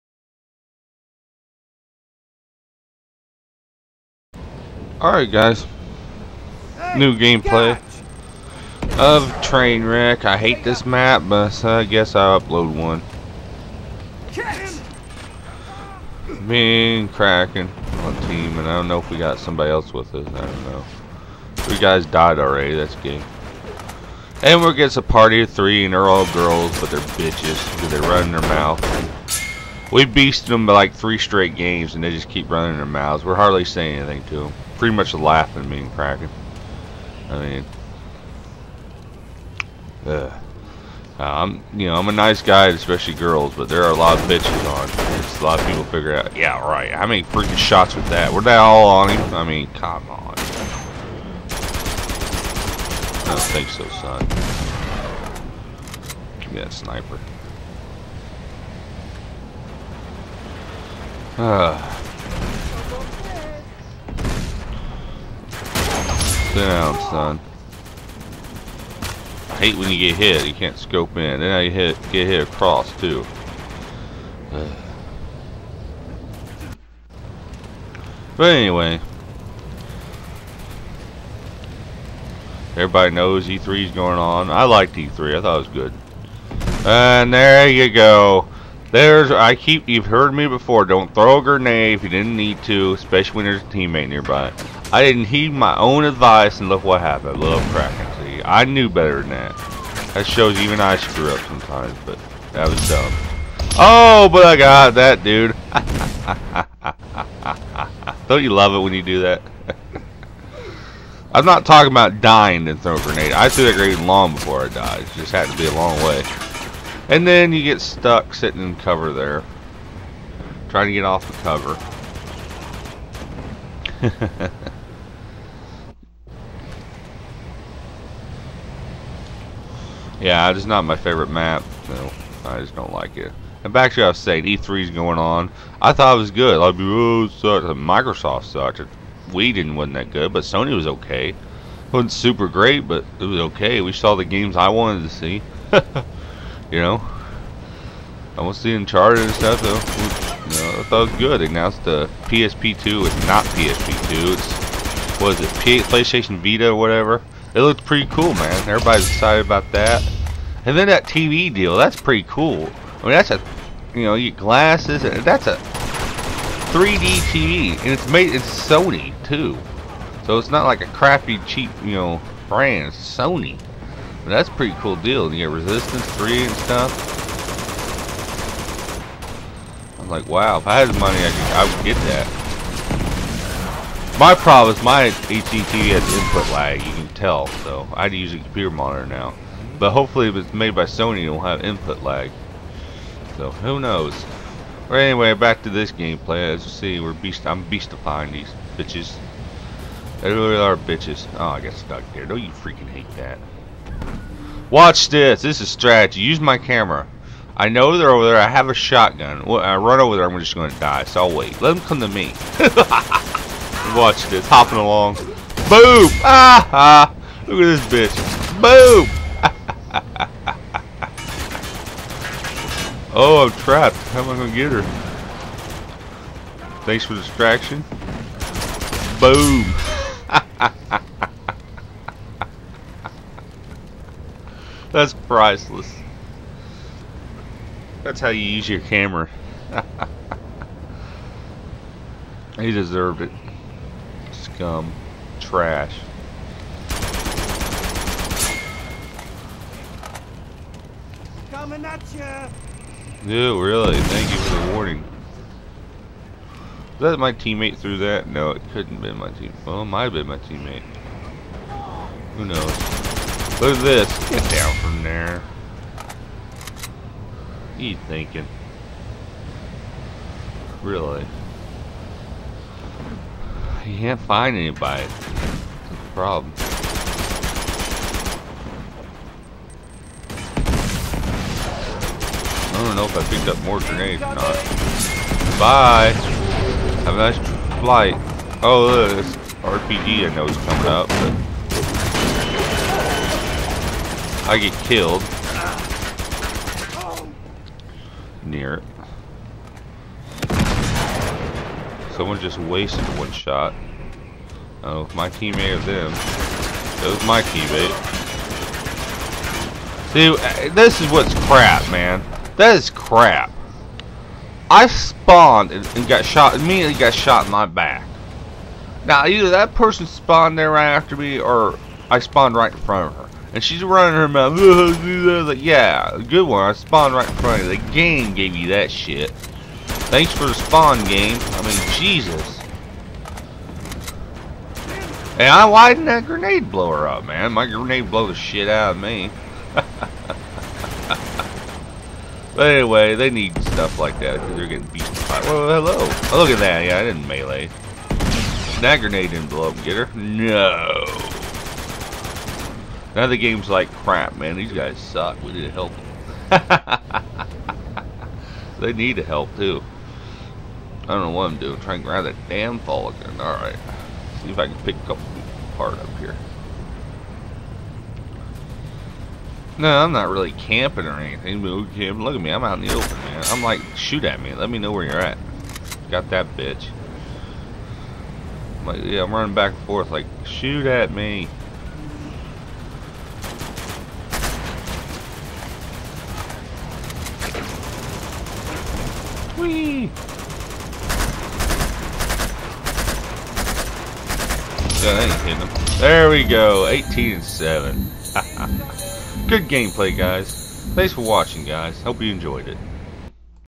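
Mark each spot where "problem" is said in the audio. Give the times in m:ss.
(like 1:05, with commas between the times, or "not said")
3:04, 4:36.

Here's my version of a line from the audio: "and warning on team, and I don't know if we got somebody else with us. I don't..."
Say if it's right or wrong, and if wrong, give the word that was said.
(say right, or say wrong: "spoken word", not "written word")
wrong: "cracking", not "warning".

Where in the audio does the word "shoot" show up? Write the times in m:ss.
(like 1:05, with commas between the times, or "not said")
6:13, 6:20.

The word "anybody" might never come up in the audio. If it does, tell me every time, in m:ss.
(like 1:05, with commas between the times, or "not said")
4:34.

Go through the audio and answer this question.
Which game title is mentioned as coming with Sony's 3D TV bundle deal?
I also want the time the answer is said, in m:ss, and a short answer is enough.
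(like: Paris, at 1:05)
Resistance 3, at 2:55.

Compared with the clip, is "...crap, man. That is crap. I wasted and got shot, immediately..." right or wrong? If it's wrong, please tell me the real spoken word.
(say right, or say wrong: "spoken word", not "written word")
wrong: "spawned", not "wasted".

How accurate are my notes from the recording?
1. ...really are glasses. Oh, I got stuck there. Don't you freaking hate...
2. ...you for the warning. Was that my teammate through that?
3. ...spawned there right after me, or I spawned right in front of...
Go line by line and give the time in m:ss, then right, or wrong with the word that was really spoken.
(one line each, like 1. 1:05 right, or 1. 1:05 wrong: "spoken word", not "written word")
1. 3:20 wrong: "bitches", not "glasses"
2. 4:14 right
3. 5:20 right.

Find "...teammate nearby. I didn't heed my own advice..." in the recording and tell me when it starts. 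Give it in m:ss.
1:33.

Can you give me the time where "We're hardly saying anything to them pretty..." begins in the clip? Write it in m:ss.
0:33.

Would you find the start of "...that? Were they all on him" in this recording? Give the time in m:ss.
0:48.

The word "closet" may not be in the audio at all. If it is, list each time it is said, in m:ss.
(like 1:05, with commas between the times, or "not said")
not said.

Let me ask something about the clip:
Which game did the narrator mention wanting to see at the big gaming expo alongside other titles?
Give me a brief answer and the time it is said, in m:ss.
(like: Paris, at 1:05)
Uncharted, at 2:28.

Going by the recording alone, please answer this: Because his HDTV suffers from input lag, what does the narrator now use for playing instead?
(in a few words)
Computer monitor.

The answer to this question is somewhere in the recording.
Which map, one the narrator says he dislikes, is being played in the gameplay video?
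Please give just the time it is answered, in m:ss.
0:09.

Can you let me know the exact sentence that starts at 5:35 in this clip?
Hey, I widened that grenade blower up, man.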